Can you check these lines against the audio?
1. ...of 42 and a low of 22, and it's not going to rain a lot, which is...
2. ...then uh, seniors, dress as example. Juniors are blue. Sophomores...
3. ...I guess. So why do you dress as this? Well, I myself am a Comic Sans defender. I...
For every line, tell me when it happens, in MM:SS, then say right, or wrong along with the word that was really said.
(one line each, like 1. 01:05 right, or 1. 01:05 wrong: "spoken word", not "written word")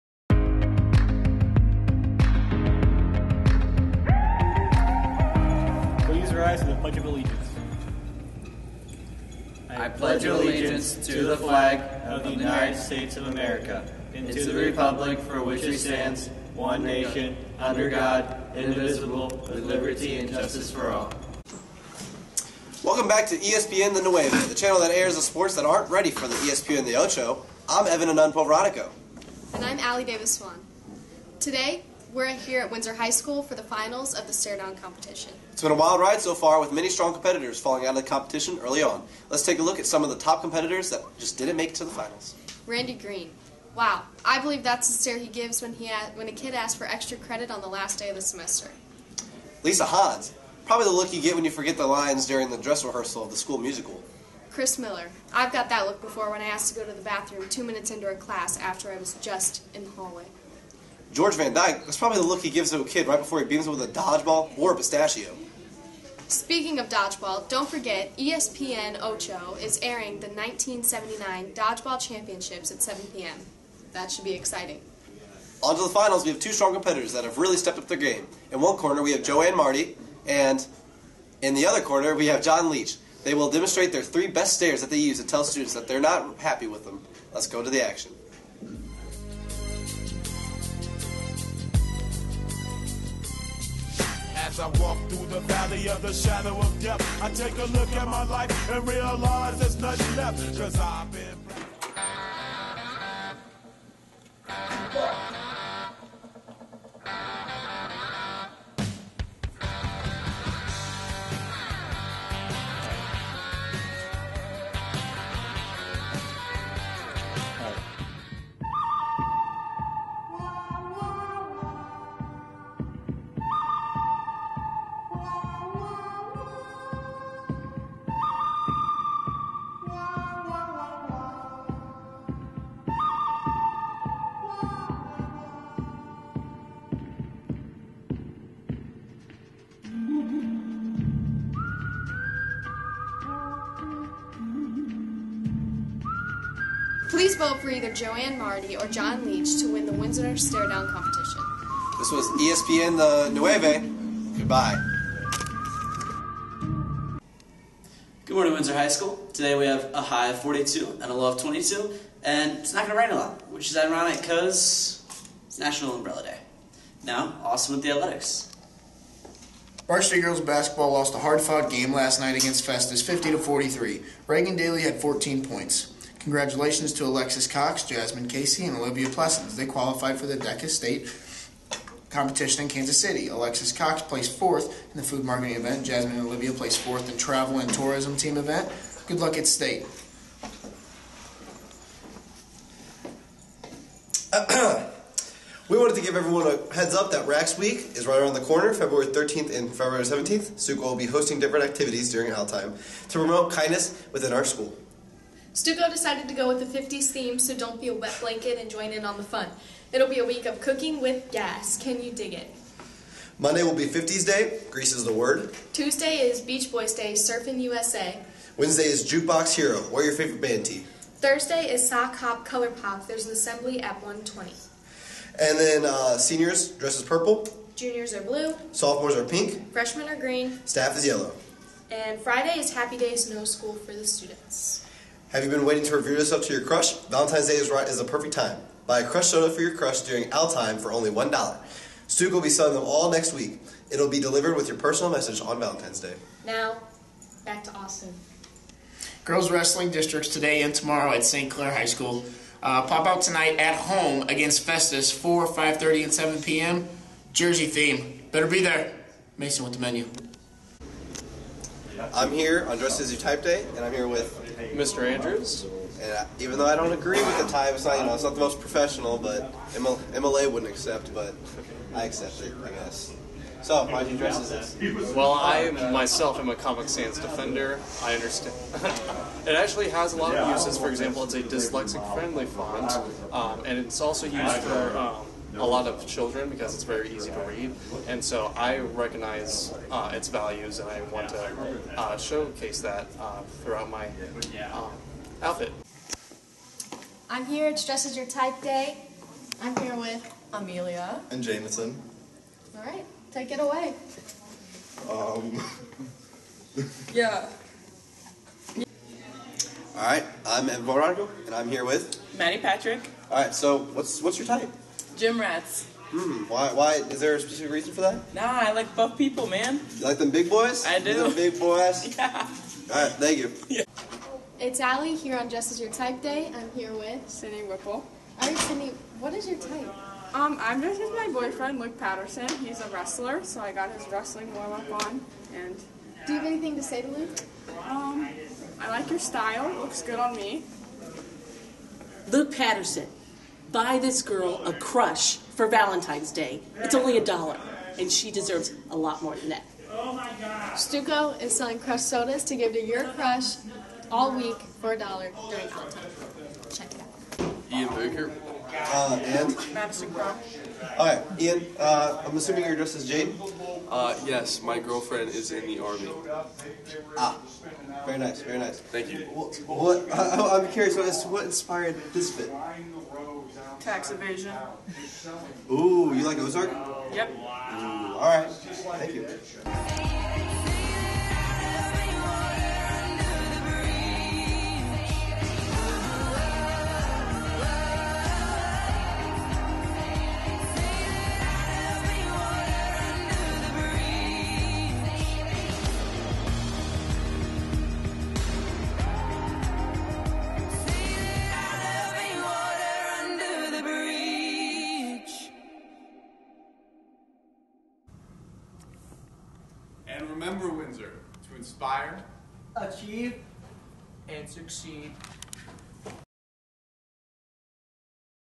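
1. 02:40 right
2. 03:45 wrong: "purple", not "example"
3. 04:32 right.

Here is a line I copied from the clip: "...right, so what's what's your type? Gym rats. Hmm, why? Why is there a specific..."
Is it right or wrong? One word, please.
right.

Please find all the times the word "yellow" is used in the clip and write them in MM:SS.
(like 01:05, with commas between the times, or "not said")
03:51.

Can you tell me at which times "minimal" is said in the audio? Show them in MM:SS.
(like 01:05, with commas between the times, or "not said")
not said.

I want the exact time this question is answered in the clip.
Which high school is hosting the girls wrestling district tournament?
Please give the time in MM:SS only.
04:11.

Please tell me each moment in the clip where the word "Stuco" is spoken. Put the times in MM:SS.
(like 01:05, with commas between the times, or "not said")
03:25, 05:50.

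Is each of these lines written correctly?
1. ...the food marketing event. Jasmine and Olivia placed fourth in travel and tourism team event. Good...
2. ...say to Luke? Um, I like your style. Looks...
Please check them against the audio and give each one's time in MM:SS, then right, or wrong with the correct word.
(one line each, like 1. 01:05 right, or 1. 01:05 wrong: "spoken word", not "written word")
1. 03:04 right
2. 05:36 right.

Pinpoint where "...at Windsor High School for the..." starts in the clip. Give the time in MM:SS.
00:32.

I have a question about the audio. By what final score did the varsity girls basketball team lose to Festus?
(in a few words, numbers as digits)
50 to 43.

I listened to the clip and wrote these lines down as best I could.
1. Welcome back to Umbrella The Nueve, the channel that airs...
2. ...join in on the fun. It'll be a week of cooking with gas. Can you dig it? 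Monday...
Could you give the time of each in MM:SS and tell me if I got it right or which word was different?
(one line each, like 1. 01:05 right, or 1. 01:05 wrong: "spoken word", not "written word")
1. 00:22 wrong: "ESPN", not "Umbrella"
2. 03:28 right.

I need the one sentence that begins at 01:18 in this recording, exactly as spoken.
In one corner, we have Joanne Marty, and in the other corner, we have John Leach.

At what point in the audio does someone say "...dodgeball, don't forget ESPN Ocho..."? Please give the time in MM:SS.
01:06.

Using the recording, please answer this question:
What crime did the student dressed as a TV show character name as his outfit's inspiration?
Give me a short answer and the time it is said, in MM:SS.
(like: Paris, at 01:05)
Tax evasion, at 06:13.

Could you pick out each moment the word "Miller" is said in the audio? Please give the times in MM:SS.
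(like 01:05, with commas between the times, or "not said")
00:54.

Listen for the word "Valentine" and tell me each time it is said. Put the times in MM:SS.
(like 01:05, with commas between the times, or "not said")
03:57, 04:05, 05:45, 05:55.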